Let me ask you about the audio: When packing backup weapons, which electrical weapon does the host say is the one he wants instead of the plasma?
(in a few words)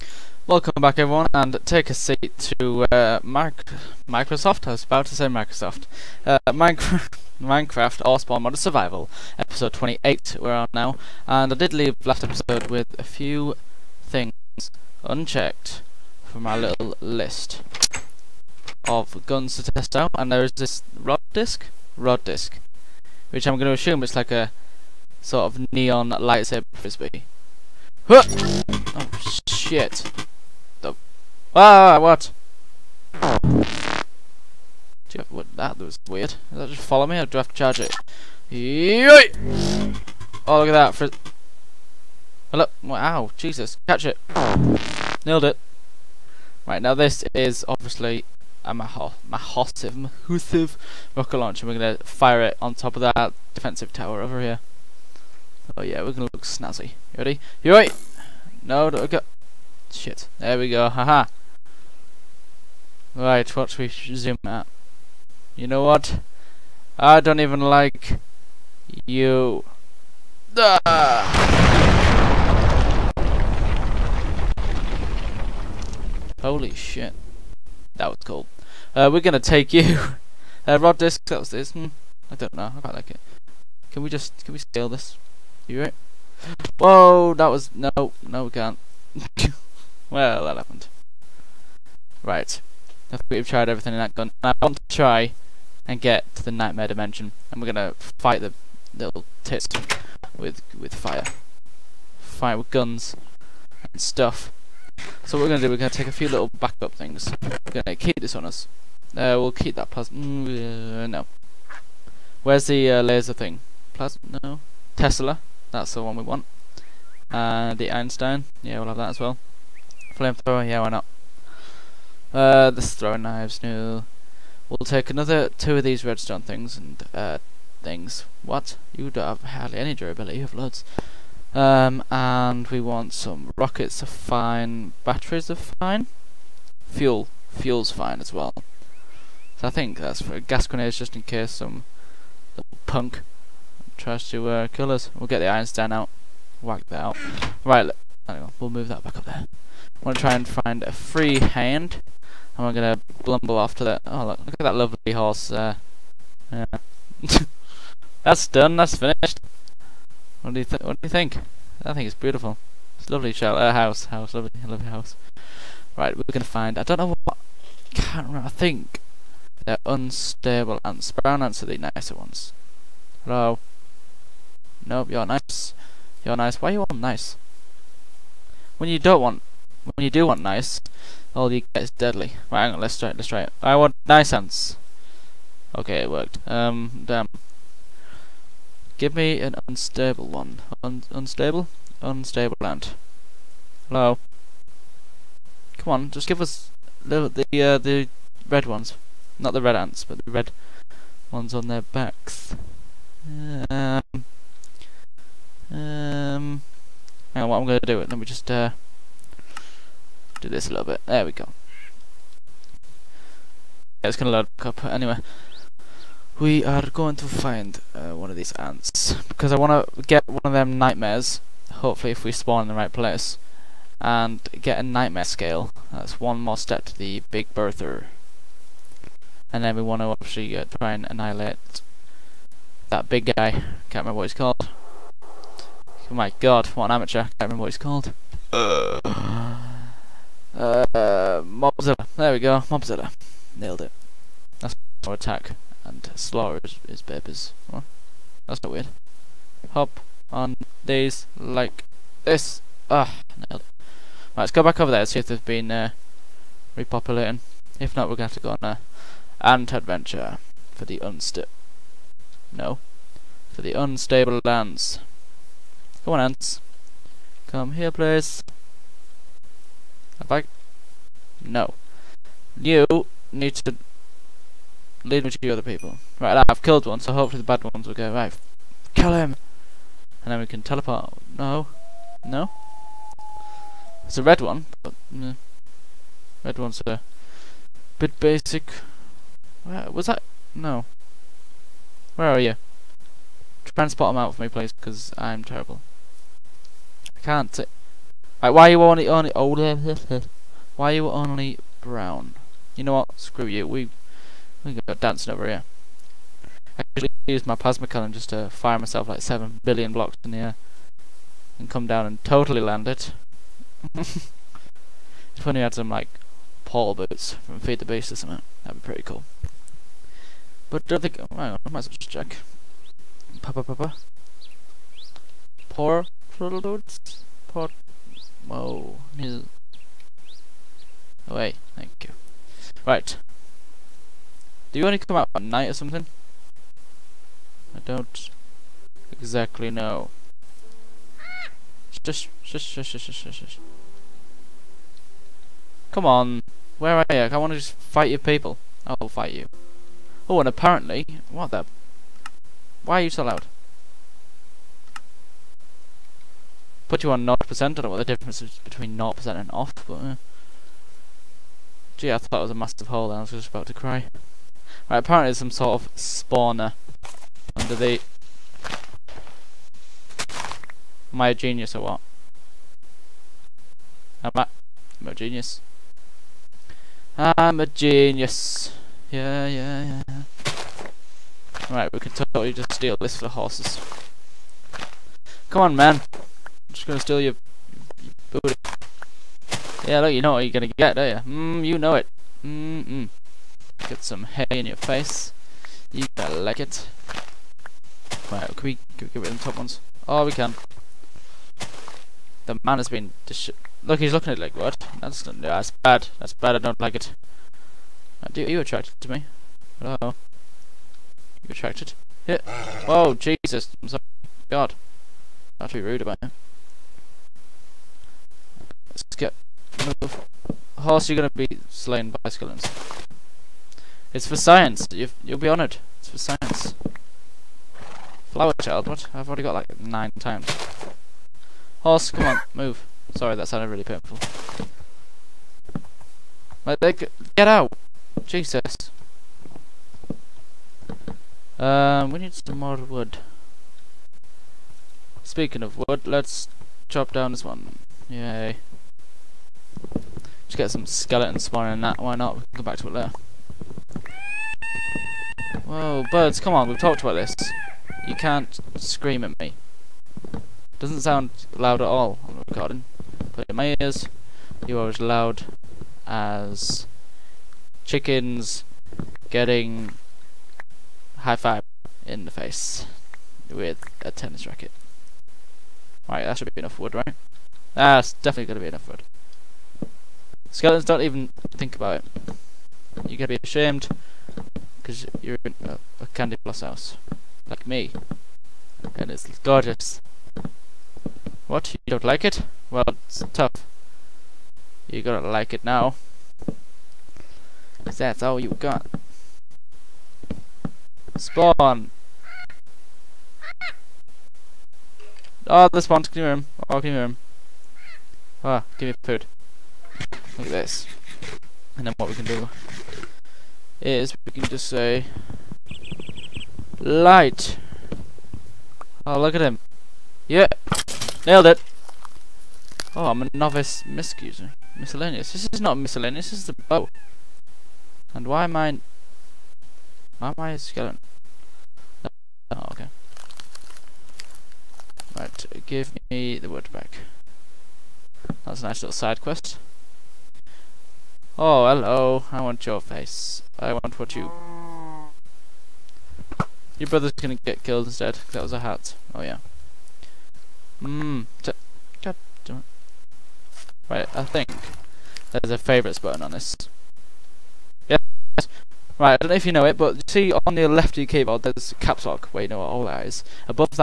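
Tesla.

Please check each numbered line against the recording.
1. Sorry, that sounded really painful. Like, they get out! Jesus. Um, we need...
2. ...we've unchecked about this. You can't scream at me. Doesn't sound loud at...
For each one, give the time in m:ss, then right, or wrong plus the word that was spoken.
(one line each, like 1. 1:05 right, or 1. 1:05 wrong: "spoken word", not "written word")
1. 7:13 right
2. 7:36 wrong: "talked", not "unchecked".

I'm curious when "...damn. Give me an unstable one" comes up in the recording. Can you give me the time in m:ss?
3:07.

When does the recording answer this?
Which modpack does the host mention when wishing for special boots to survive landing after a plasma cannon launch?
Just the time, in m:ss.
5:17.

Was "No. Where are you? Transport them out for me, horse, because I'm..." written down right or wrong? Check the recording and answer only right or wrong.
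wrong.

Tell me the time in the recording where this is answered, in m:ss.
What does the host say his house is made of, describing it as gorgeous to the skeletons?
8:06.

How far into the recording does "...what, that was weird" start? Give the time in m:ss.
0:35.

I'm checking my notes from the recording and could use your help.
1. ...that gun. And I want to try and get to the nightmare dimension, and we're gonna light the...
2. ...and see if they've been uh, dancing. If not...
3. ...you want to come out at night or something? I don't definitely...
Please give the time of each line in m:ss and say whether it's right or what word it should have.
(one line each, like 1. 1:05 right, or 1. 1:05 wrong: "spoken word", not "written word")
1. 1:34 wrong: "fight", not "light"
2. 4:15 wrong: "repopulating", not "dancing"
3. 5:34 wrong: "exactly", not "definitely".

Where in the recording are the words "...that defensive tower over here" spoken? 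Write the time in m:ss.
0:53.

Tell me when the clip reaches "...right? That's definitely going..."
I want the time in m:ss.
7:56.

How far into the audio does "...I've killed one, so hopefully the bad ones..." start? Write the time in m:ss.
4:36.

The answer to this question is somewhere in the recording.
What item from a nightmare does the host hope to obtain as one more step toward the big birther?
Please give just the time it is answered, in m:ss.
3:44.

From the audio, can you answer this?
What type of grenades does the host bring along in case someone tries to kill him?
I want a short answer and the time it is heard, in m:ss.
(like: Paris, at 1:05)
Gas grenades, at 2:20.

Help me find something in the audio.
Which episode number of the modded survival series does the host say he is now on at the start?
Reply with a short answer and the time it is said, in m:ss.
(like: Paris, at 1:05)
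28, at 0:09.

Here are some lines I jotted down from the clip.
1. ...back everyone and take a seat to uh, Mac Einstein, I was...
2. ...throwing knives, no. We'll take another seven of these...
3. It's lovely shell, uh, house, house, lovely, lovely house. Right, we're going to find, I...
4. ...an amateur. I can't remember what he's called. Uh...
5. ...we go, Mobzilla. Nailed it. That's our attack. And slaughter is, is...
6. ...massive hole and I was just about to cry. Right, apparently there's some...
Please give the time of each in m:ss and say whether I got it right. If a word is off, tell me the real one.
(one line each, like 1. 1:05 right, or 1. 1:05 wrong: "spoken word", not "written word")
1. 0:00 wrong: "Microsoft", not "Einstein"
2. 2:02 wrong: "two", not "seven"
3. 2:42 right
4. 3:56 right
5. 4:02 right
6. 6:02 right.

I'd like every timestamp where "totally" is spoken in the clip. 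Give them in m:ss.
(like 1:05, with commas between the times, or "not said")
5:12, 6:22.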